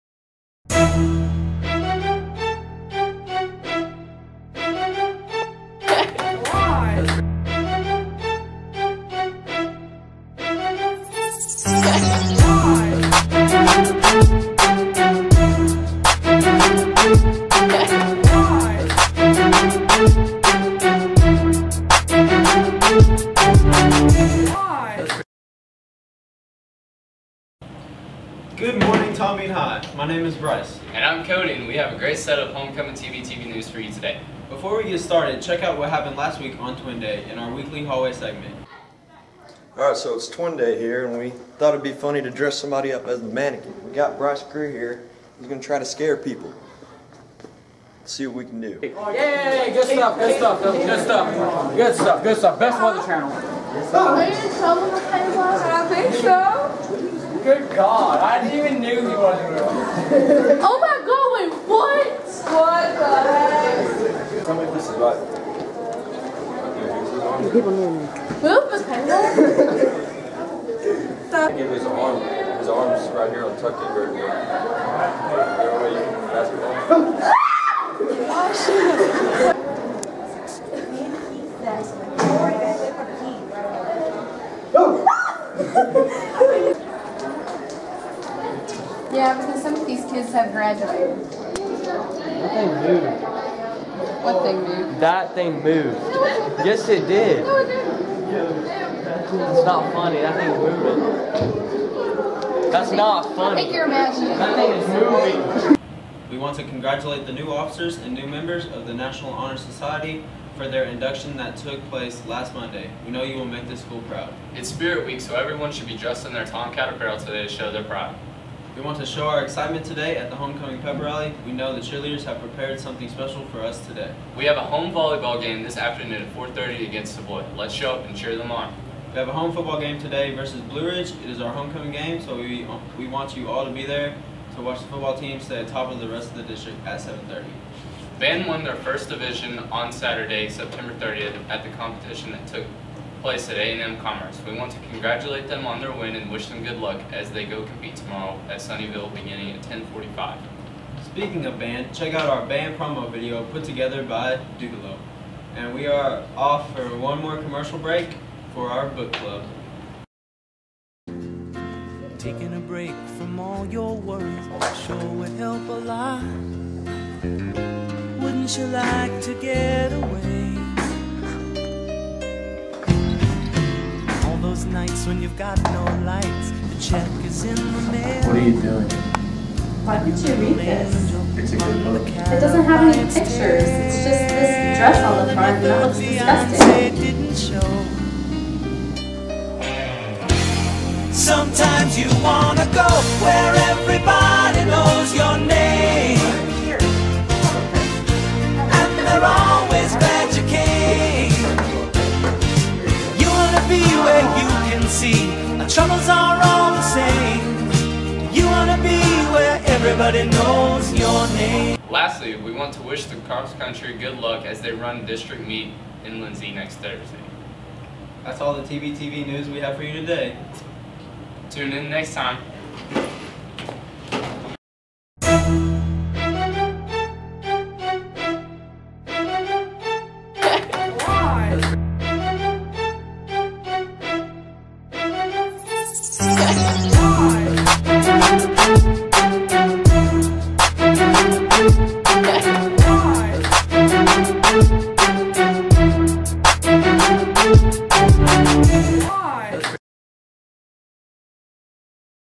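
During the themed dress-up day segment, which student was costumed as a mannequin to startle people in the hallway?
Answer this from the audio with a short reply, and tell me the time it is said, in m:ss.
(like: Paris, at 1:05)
Bryce Greer, at 0:44.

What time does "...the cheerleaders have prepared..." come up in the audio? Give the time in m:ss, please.
2:01.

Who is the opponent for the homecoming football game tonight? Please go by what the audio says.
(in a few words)
Blue Ridge.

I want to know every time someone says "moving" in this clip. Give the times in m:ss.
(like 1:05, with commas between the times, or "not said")
1:40, 1:45.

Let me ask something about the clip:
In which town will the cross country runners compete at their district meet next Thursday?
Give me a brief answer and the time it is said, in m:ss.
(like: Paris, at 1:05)
Lindsay, at 3:36.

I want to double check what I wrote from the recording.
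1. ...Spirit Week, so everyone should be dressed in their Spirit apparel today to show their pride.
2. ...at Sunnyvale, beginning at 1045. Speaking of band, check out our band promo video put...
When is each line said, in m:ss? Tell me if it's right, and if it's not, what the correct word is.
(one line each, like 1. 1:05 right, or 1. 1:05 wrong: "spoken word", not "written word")
1. 1:54 wrong: "Tomcat", not "Spirit"
2. 2:28 right.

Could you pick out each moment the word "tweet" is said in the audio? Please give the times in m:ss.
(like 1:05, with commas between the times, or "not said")
not said.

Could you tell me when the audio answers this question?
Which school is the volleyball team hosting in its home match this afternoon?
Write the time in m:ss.
2:07.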